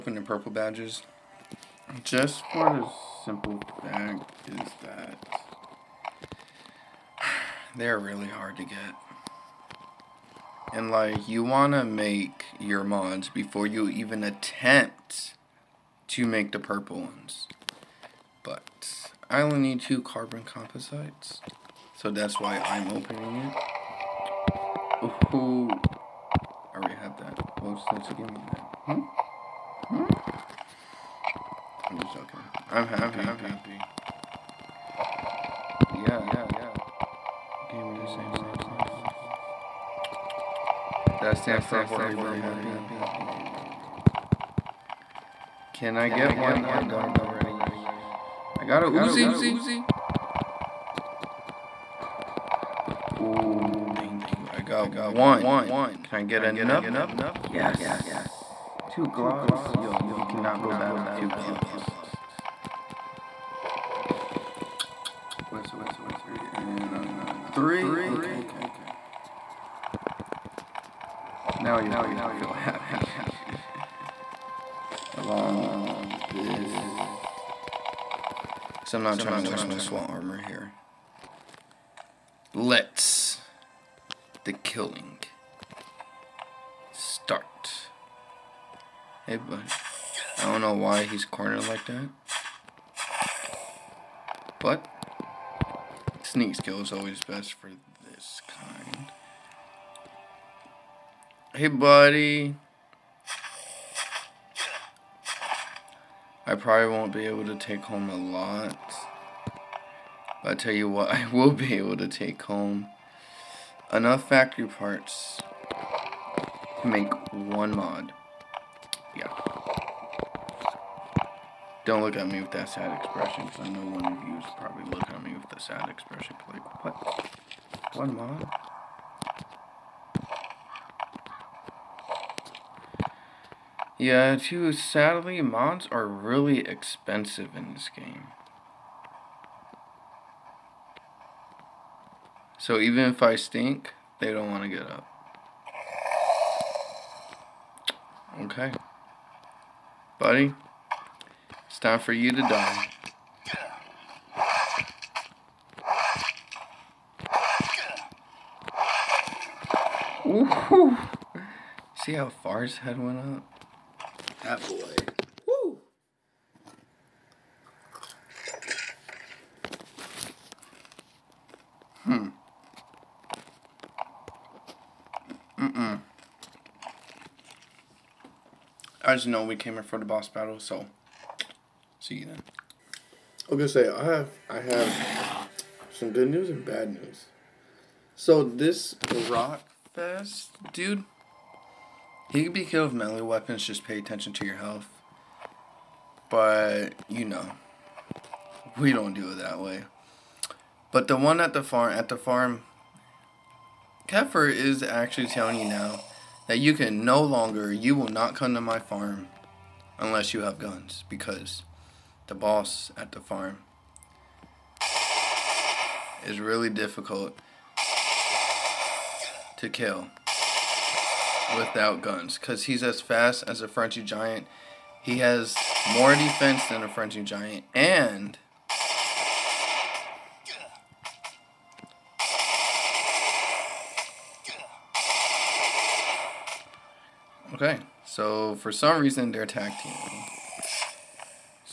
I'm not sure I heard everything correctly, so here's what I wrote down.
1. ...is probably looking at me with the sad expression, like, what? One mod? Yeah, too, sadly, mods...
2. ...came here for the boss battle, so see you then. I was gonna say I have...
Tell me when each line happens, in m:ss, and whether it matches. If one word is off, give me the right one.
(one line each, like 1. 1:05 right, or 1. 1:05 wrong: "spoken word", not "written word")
1. 2:04 right
2. 2:59 right.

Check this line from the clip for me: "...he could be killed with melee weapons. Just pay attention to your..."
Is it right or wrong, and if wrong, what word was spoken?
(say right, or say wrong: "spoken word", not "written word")
right.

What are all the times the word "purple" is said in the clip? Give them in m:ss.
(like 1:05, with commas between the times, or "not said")
0:00, 0:16.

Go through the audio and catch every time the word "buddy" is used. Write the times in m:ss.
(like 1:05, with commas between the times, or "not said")
1:41, 2:30.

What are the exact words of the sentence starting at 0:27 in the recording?
What's that to give me that?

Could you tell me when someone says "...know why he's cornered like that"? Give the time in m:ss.
1:30.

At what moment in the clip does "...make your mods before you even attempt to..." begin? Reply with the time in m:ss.
0:11.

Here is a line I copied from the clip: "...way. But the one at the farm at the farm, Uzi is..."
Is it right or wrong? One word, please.
wrong.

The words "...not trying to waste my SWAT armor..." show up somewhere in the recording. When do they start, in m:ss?
1:19.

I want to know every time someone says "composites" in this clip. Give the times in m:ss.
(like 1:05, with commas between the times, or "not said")
0:20.